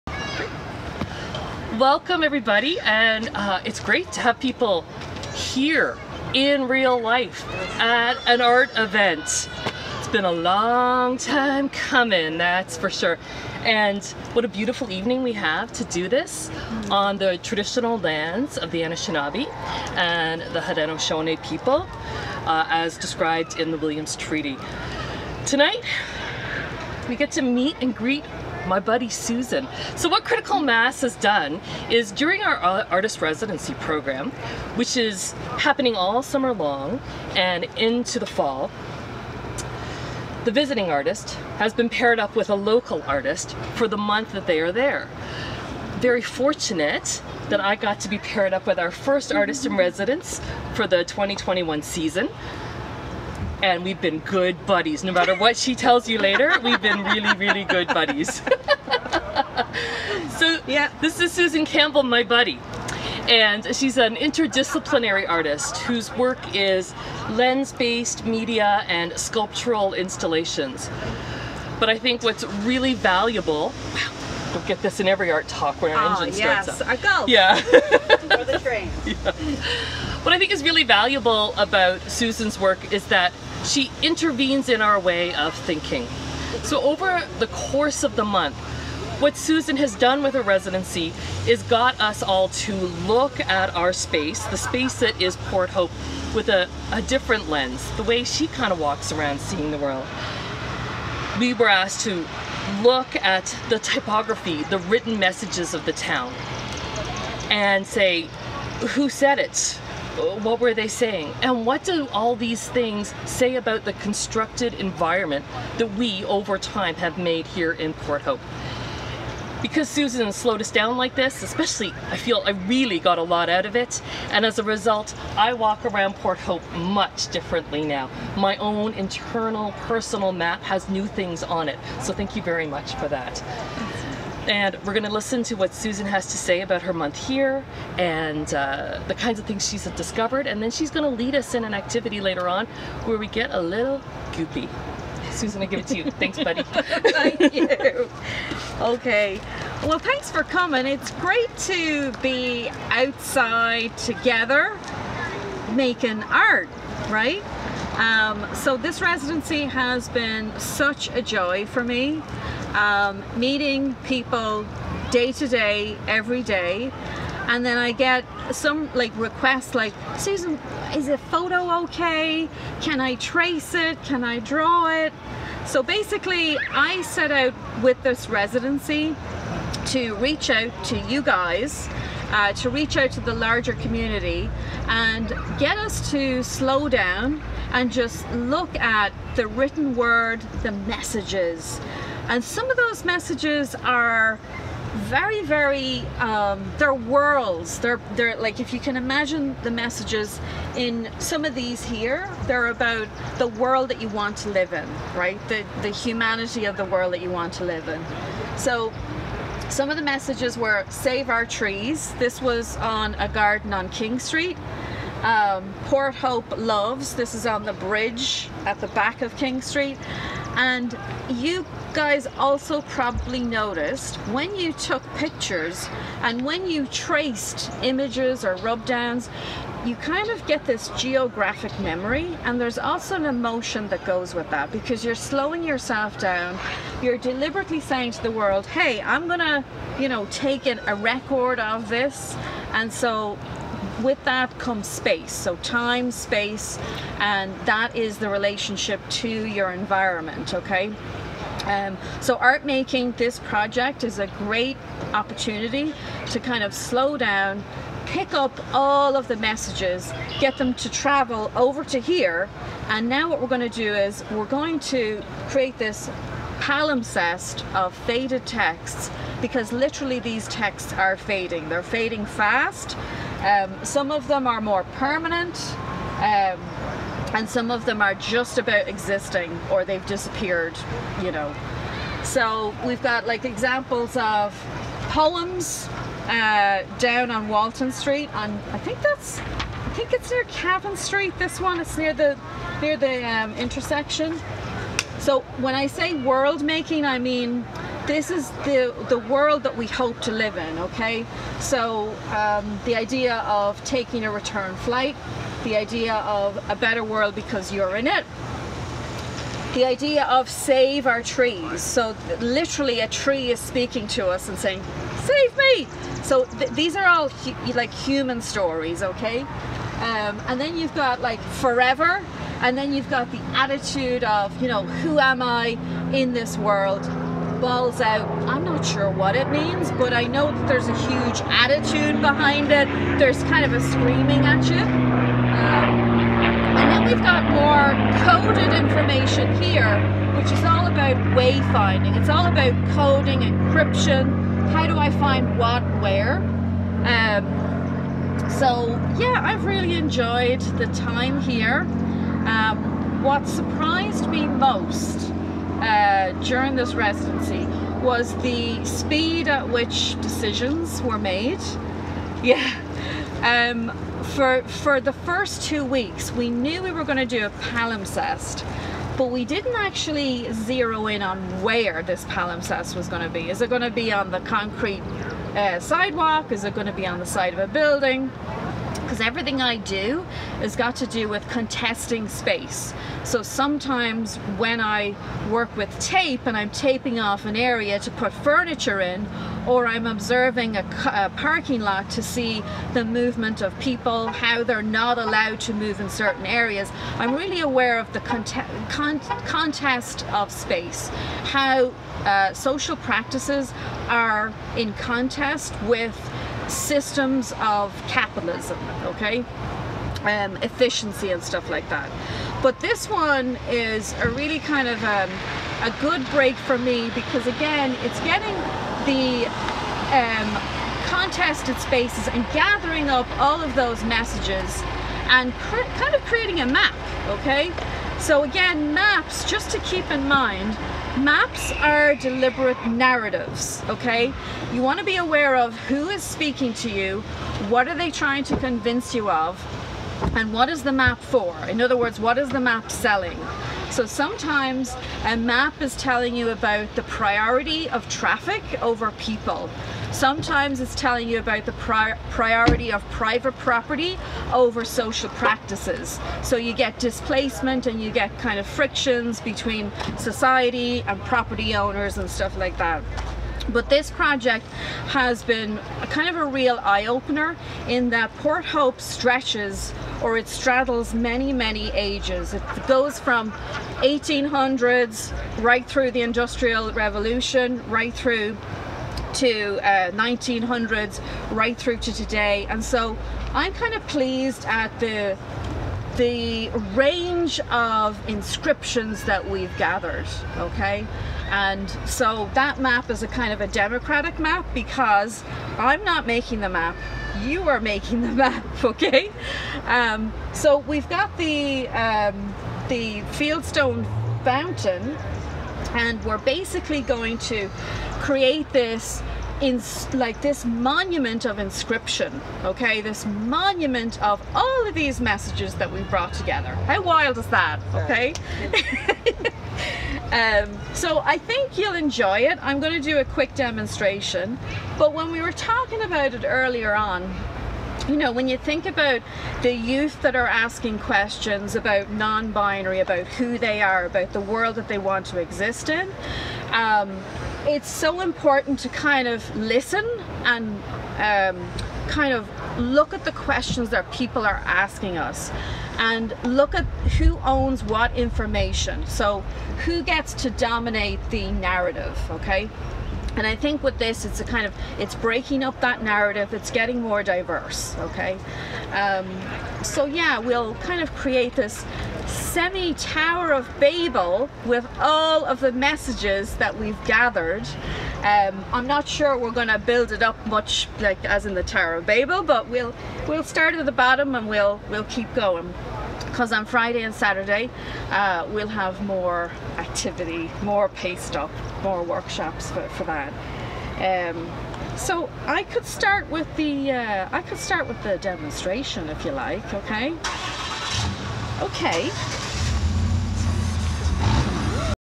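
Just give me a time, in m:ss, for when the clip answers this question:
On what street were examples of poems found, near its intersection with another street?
4:47.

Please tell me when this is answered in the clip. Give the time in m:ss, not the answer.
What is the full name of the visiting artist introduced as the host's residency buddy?
1:01.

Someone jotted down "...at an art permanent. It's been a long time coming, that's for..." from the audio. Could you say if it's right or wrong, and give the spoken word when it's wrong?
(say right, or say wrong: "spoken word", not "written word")
wrong: "event", not "permanent".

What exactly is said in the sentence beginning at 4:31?
They're fading fast um, some of them are more permanent.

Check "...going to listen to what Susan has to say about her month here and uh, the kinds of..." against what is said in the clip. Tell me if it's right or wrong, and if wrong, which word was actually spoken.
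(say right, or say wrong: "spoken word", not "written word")
right.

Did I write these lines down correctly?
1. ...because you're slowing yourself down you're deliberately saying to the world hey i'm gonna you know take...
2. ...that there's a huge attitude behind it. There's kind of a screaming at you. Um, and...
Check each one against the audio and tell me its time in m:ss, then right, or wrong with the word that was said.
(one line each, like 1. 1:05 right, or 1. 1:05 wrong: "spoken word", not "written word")
1. 3:54 right
2. 5:30 right.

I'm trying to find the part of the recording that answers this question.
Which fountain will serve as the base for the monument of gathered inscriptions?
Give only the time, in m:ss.
8:23.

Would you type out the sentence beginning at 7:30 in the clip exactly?
Sometimes it's telling you about the pri priority of private property over social practices.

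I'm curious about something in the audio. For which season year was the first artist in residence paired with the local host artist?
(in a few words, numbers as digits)
2021.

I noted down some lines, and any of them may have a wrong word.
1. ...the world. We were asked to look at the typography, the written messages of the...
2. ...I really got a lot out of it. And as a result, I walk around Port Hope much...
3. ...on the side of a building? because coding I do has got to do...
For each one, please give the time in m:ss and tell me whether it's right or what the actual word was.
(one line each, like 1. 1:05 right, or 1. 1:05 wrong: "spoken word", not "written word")
1. 1:39 right
2. 2:02 right
3. 6:17 wrong: "everything", not "coding".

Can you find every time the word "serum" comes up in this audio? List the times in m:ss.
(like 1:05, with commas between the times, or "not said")
not said.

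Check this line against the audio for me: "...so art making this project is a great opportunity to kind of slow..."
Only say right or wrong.
right.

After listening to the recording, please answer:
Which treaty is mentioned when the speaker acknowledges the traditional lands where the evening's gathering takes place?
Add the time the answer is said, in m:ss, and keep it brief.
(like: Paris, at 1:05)
Williams Treaty, at 0:23.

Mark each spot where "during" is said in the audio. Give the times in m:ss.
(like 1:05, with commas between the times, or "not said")
0:32, 5:56.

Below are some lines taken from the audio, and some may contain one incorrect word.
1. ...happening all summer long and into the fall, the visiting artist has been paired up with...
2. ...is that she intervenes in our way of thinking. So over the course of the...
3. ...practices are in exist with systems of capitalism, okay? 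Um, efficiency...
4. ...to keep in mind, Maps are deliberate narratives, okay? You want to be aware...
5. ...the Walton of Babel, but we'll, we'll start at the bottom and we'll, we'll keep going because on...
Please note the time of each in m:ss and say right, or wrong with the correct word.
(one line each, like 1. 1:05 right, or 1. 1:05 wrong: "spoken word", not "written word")
1. 0:35 right
2. 1:22 right
3. 6:42 wrong: "contest", not "exist"
4. 7:09 right
5. 9:31 wrong: "Tower", not "Walton".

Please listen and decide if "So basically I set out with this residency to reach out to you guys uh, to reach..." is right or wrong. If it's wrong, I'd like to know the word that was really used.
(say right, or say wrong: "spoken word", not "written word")
right.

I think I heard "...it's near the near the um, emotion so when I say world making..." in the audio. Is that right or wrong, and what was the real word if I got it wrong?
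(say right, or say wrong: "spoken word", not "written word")
wrong: "intersection", not "emotion".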